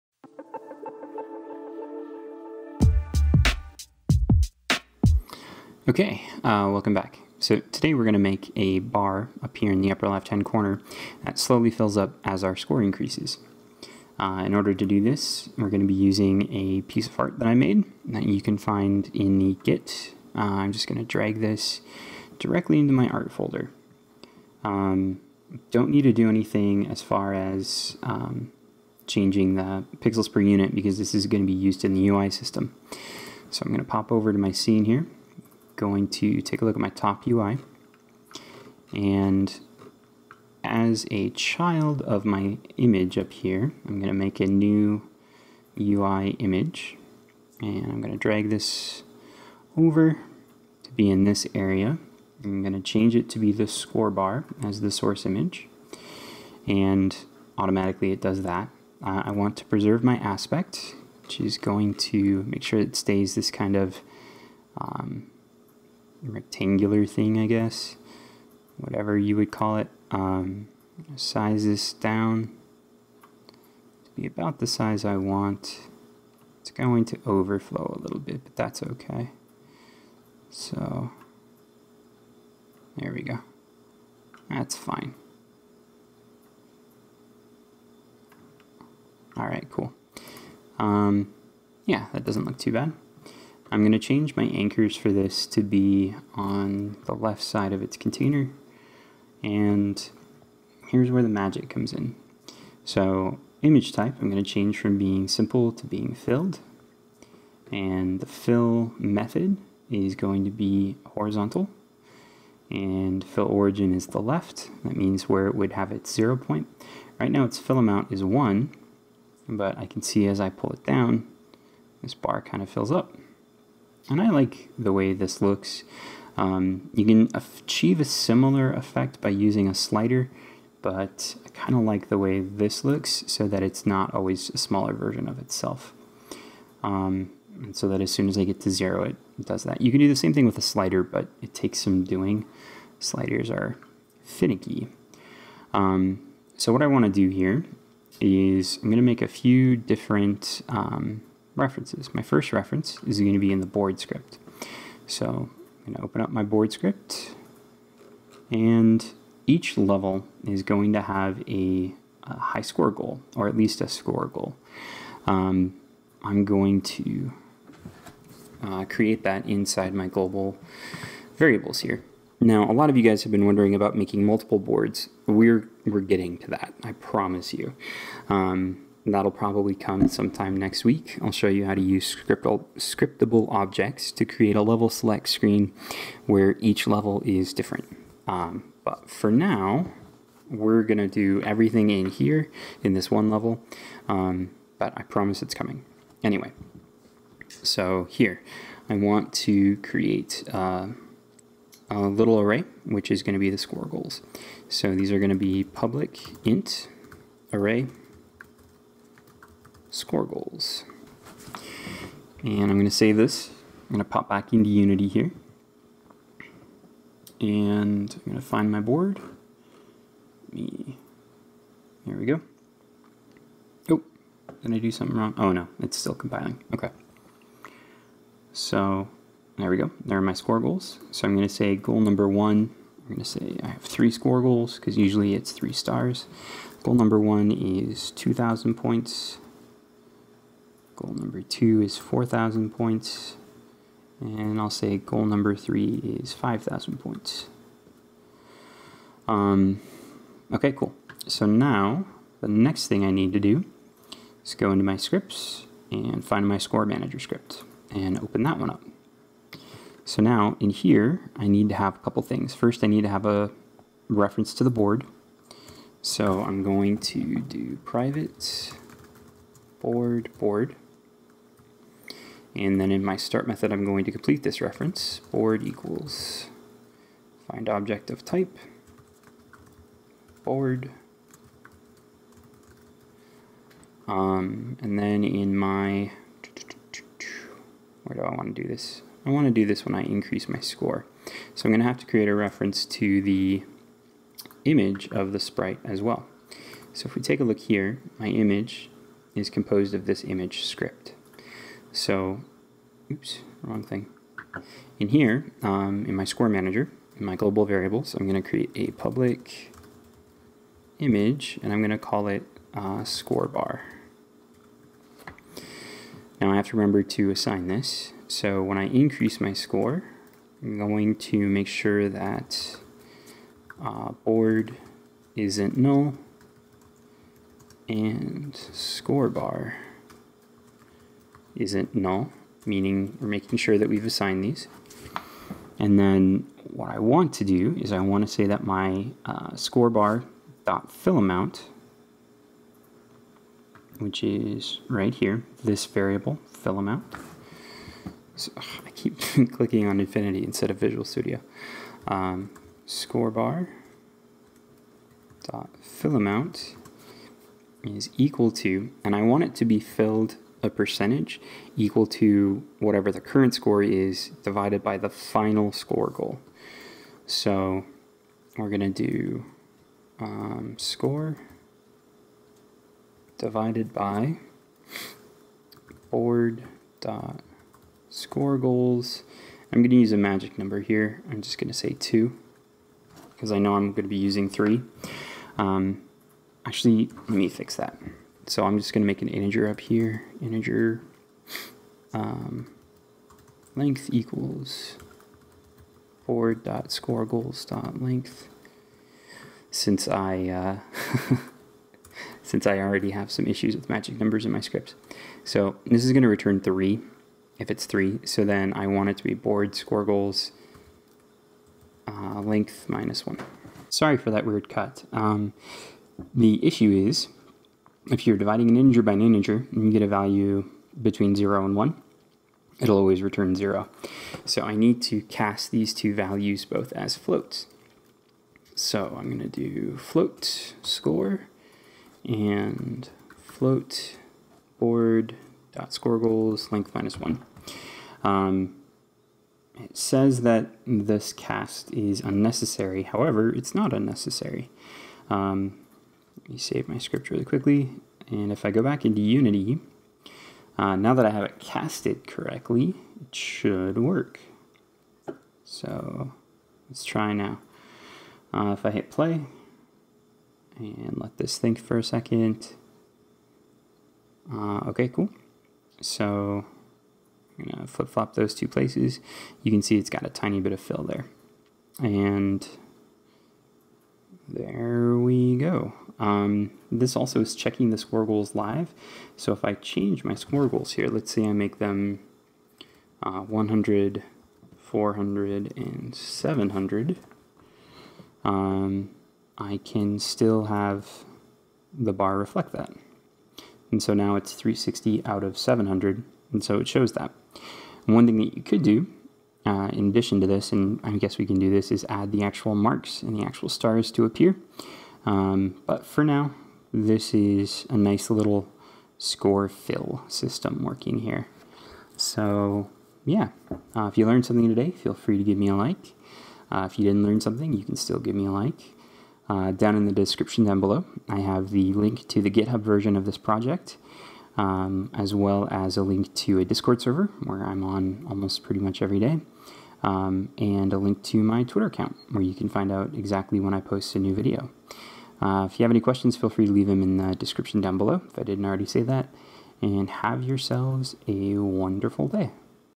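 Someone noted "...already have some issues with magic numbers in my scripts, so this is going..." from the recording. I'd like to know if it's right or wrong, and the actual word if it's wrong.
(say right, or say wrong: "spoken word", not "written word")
right.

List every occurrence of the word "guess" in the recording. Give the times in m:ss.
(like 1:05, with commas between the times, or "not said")
1:07, 8:21.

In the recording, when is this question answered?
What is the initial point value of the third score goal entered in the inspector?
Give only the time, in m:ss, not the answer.
4:06.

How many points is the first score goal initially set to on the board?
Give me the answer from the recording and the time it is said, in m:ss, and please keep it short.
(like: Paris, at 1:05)
2000, at 3:58.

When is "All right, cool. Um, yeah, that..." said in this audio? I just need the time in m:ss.
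1:29.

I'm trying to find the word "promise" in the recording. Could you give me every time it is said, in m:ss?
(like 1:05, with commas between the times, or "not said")
2:56, 3:15.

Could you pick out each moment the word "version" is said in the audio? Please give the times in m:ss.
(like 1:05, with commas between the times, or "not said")
2:14, 8:42.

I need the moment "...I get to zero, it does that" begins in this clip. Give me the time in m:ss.
2:18.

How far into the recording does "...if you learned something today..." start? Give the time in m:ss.
8:34.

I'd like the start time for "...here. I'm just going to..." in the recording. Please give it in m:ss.
6:20.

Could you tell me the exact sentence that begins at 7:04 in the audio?
So I need to cast these two values both as floats.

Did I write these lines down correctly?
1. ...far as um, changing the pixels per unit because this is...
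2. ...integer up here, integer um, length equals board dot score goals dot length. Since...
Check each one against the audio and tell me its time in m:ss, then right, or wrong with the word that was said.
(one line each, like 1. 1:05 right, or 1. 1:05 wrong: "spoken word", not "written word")
1. 0:27 right
2. 6:29 right.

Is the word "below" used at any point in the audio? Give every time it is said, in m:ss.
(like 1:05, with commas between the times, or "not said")
8:40, 8:57.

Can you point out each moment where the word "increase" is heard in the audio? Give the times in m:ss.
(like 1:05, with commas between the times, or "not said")
0:12, 4:50, 5:18.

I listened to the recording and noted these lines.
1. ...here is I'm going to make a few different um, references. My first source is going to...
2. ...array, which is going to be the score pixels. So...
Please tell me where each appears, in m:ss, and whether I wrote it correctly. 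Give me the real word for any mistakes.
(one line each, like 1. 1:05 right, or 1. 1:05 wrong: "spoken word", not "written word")
1. 2:27 wrong: "reference", not "source"
2. 3:22 wrong: "goals", not "pixels".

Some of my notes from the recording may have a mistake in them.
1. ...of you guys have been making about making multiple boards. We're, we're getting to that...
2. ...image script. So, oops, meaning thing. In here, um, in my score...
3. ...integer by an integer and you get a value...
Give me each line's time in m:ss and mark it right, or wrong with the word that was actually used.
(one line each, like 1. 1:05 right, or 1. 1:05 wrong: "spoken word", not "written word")
1. 2:52 wrong: "wondering", not "making"
2. 5:00 wrong: "wrong", not "meaning"
3. 6:58 right.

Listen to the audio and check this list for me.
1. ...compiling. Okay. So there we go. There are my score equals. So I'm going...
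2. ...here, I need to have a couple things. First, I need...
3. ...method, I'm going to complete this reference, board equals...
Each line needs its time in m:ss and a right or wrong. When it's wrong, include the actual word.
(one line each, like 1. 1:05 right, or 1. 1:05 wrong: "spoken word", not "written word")
1. 3:46 wrong: "goals", not "equals"
2. 4:20 right
3. 4:33 right.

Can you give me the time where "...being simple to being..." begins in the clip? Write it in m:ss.
1:44.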